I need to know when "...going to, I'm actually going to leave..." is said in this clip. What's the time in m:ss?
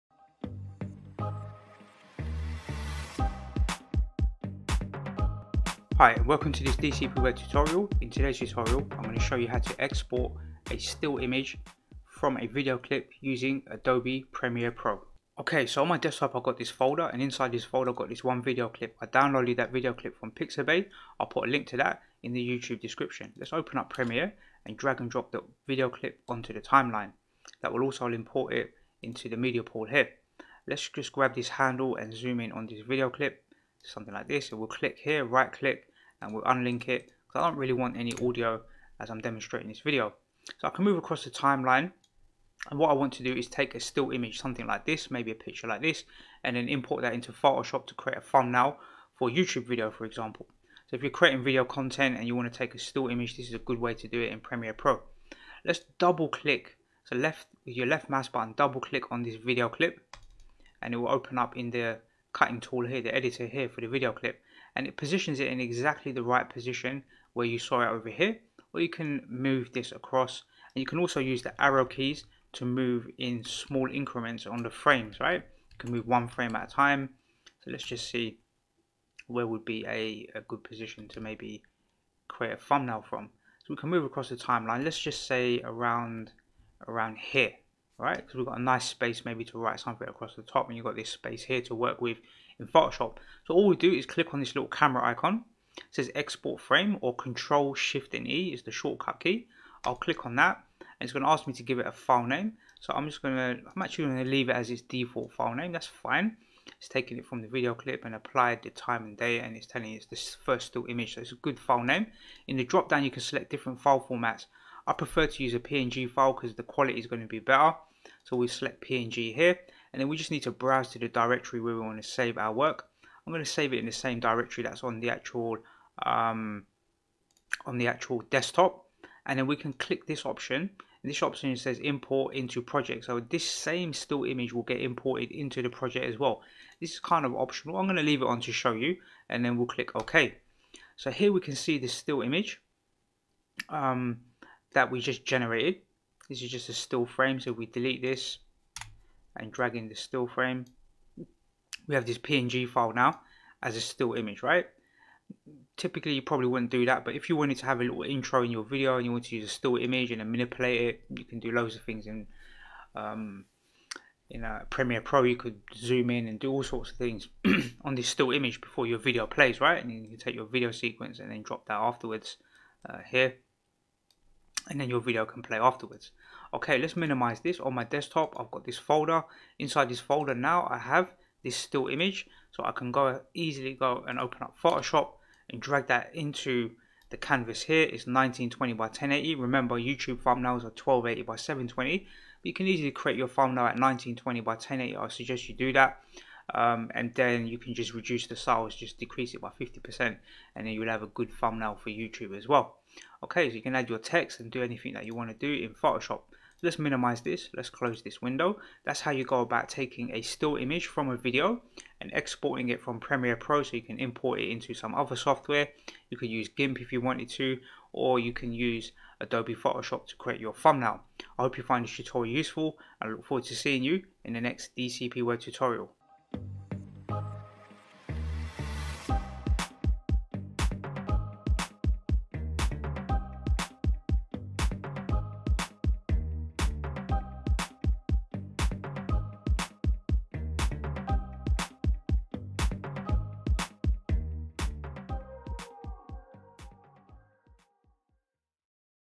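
1:43.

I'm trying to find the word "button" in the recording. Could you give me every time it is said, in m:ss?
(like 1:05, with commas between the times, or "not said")
0:58.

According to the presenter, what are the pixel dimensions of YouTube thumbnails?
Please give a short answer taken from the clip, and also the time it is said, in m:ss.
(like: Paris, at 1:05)
1280 by 720, at 3:10.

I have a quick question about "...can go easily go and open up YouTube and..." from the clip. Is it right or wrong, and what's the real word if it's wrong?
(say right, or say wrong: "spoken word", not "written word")
wrong: "Photoshop", not "YouTube".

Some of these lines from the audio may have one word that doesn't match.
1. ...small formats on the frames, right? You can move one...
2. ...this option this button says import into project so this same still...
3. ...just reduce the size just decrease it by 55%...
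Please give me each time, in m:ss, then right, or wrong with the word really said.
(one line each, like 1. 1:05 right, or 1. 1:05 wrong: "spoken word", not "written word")
1. 1:13 wrong: "increments", not "formats"
2. 2:10 wrong: "option", not "button"
3. 3:17 wrong: "50", not "55".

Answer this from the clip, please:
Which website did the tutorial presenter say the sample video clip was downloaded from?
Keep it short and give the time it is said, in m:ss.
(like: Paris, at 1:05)
Pixabay, at 0:20.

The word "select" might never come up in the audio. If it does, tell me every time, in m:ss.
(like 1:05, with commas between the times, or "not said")
1:53, 1:58.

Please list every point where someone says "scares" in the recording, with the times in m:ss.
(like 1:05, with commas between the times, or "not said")
not said.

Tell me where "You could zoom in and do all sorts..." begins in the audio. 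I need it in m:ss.
2:45.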